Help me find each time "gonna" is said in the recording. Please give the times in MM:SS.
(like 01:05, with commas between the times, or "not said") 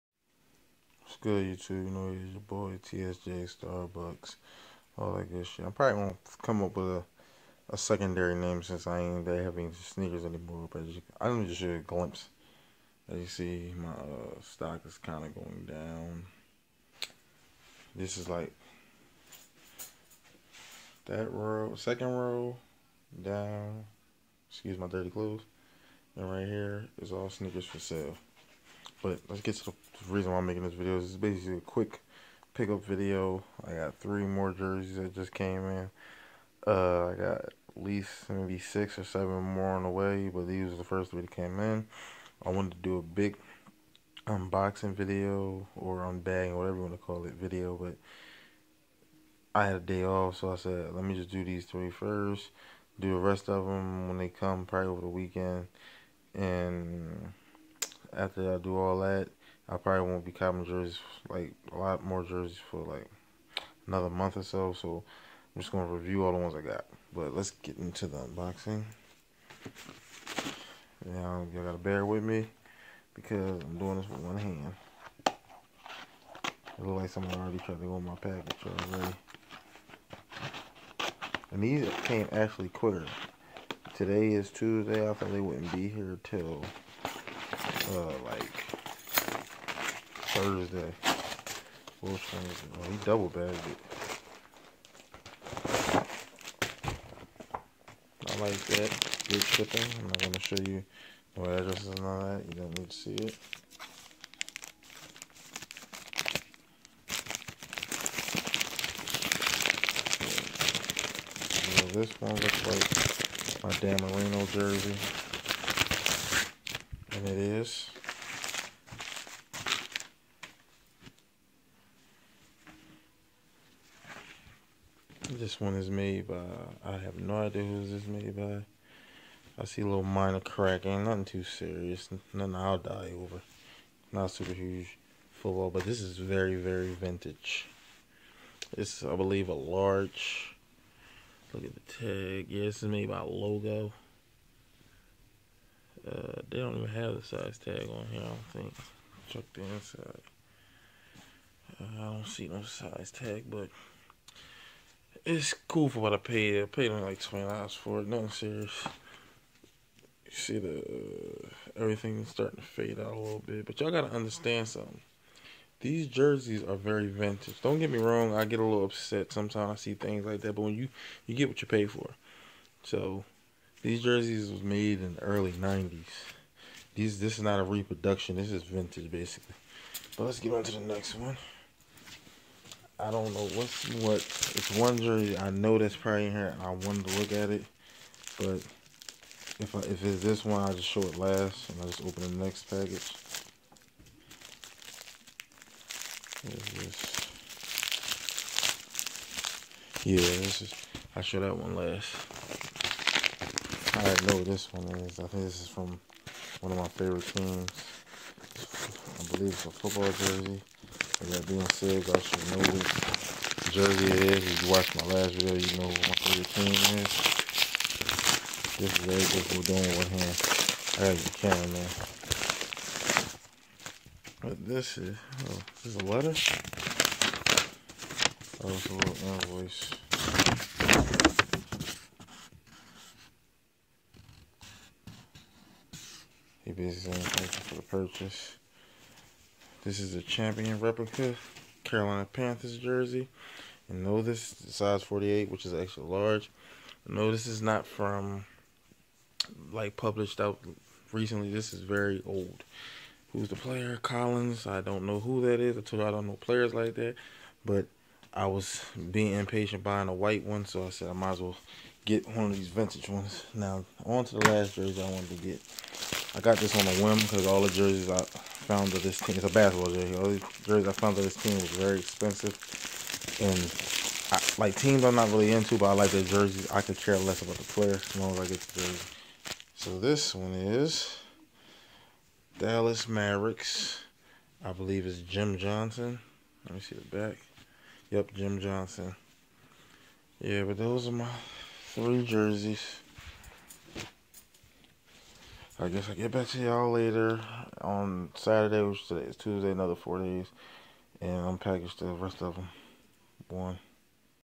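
01:05, 01:40.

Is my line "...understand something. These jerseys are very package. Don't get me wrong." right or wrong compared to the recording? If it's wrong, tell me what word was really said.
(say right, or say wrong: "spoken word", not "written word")
wrong: "vintage", not "package".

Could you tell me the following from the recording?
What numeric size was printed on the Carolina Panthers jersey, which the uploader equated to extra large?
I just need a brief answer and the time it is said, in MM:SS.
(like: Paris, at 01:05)
48, at 04:05.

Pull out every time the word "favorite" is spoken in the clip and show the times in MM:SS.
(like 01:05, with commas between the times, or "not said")
03:26, 03:36.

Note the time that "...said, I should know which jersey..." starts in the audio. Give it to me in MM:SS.
03:31.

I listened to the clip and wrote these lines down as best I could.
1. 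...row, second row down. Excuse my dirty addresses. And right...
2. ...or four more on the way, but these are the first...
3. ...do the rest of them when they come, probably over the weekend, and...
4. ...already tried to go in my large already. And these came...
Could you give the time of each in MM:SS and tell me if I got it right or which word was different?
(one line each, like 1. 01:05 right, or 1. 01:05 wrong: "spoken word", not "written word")
1. 00:21 wrong: "clothes", not "addresses"
2. 00:38 wrong: "seven", not "four"
3. 00:52 right
4. 01:17 wrong: "package", not "large".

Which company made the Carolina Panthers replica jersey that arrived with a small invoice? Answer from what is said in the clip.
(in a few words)
Champion.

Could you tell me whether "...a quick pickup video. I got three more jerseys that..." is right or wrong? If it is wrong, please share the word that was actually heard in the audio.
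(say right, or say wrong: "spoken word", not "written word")
right.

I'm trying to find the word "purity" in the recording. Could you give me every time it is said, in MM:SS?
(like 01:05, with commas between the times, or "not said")
not said.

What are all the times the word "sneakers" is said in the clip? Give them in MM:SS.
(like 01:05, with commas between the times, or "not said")
00:09, 00:27.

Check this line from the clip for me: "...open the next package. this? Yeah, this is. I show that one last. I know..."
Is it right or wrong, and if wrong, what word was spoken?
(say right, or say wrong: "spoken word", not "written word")
right.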